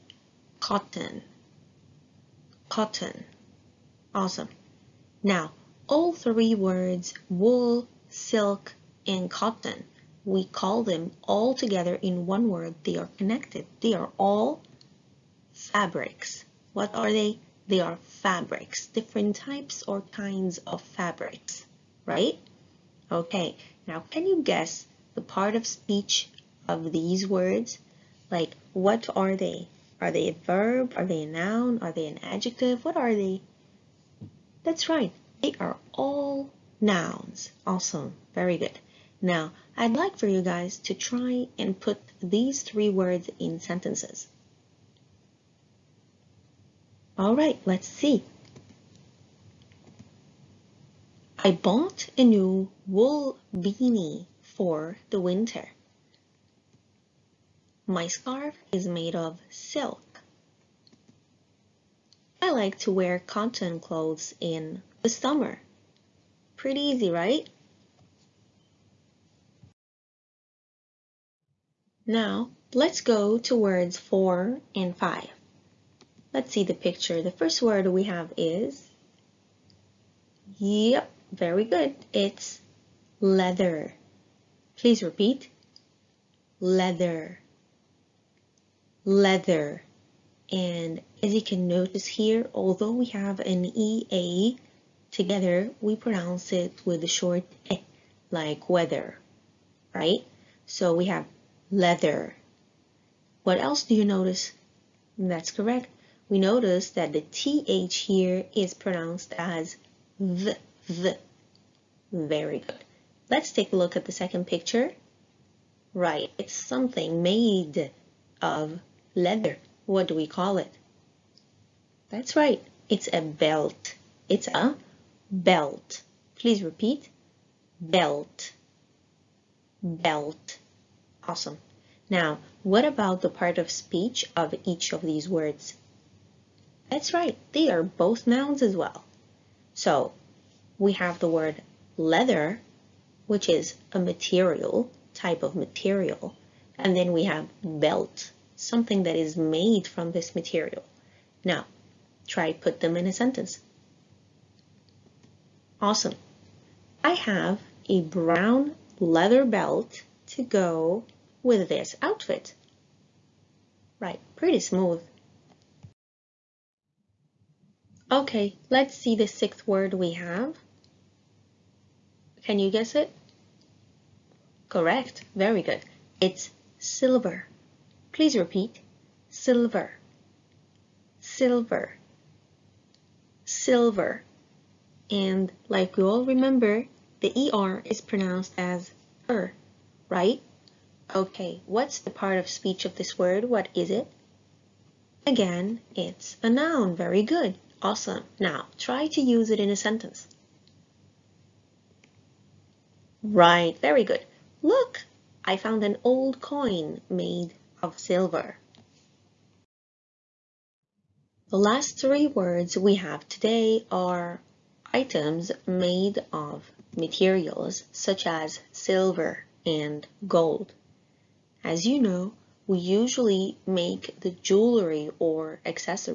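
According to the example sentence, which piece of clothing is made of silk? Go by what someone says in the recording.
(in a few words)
scarf.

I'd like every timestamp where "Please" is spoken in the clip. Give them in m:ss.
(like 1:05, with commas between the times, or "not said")
1:24, 2:06, 2:58.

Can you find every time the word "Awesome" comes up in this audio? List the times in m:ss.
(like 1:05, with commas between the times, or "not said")
0:04, 0:37, 2:11, 2:35, 3:17.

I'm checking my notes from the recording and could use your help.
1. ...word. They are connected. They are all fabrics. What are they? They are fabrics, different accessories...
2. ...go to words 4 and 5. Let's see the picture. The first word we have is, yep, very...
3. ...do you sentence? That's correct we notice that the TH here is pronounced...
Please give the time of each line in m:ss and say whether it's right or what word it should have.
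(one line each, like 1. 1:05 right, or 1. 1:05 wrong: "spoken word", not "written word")
1. 0:12 wrong: "types", not "accessories"
2. 1:13 right
3. 1:43 wrong: "notice", not "sentence".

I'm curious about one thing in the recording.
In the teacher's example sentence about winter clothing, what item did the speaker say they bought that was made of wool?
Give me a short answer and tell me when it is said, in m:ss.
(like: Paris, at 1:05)
beanie, at 0:53.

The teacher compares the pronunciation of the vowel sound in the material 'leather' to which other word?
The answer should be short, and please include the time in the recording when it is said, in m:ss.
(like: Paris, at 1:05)
weather, at 1:38.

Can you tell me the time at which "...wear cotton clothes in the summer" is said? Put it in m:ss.
1:02.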